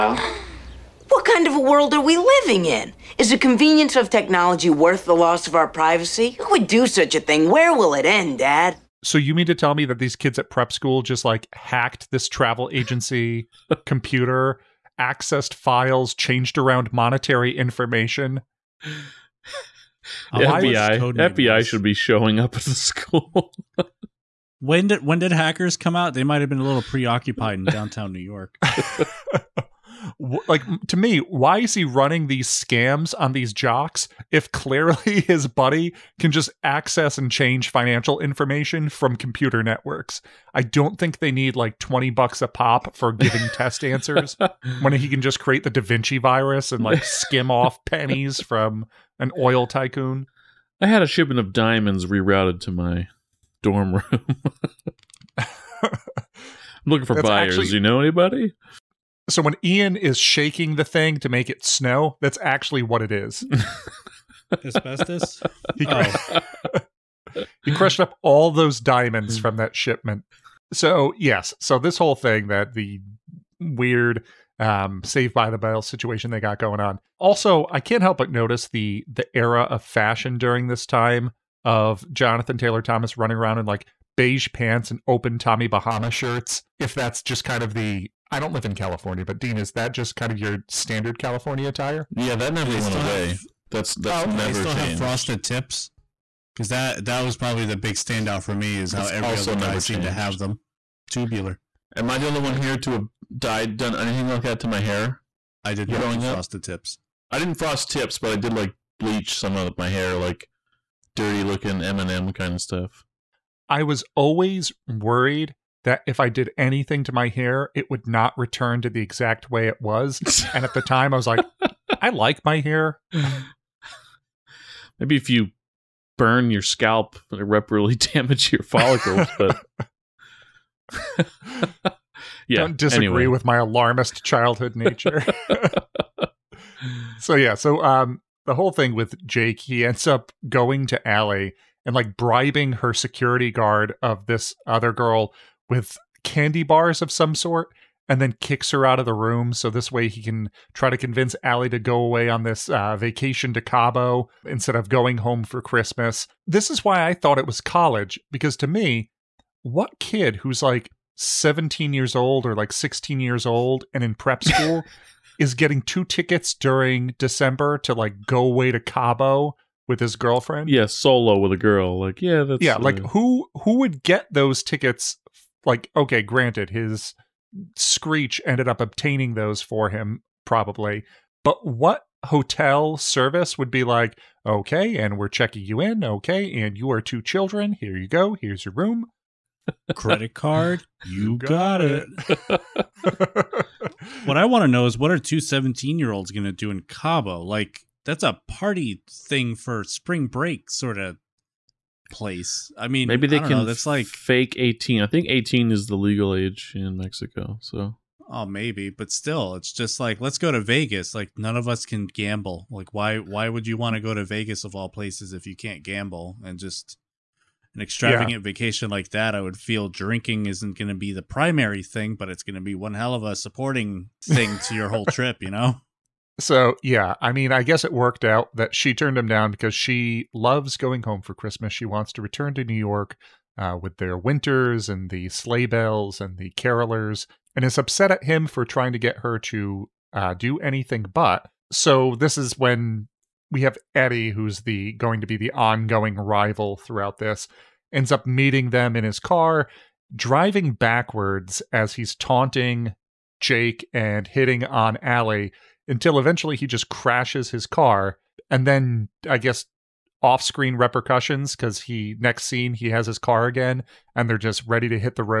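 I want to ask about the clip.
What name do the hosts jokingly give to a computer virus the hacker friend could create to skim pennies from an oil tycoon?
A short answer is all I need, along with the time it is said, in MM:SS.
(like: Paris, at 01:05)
Da Vinci virus, at 00:45.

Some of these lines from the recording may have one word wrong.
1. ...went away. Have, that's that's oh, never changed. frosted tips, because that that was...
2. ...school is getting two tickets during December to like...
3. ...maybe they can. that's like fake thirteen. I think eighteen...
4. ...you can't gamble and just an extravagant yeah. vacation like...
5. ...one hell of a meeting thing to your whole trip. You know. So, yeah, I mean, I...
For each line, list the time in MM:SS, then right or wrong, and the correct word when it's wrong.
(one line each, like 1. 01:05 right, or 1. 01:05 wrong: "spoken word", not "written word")
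1. 01:32 right
2. 02:44 right
3. 03:23 wrong: "eighteen", not "thirteen"
4. 03:35 right
5. 03:42 wrong: "supporting", not "meeting".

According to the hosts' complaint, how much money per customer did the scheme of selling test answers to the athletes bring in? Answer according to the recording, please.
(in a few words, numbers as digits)
$20.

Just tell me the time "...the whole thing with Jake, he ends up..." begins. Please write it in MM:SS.
02:18.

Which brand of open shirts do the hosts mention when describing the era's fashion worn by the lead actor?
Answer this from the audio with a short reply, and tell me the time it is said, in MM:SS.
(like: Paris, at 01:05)
Tommy Bahama, at 01:25.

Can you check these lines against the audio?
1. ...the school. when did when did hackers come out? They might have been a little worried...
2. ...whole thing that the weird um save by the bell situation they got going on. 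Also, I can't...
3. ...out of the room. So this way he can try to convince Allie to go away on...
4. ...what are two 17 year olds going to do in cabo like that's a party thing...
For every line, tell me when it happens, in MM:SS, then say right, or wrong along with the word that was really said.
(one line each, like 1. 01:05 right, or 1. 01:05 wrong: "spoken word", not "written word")
1. 00:22 wrong: "preoccupied", not "worried"
2. 01:11 right
3. 02:28 right
4. 03:14 right.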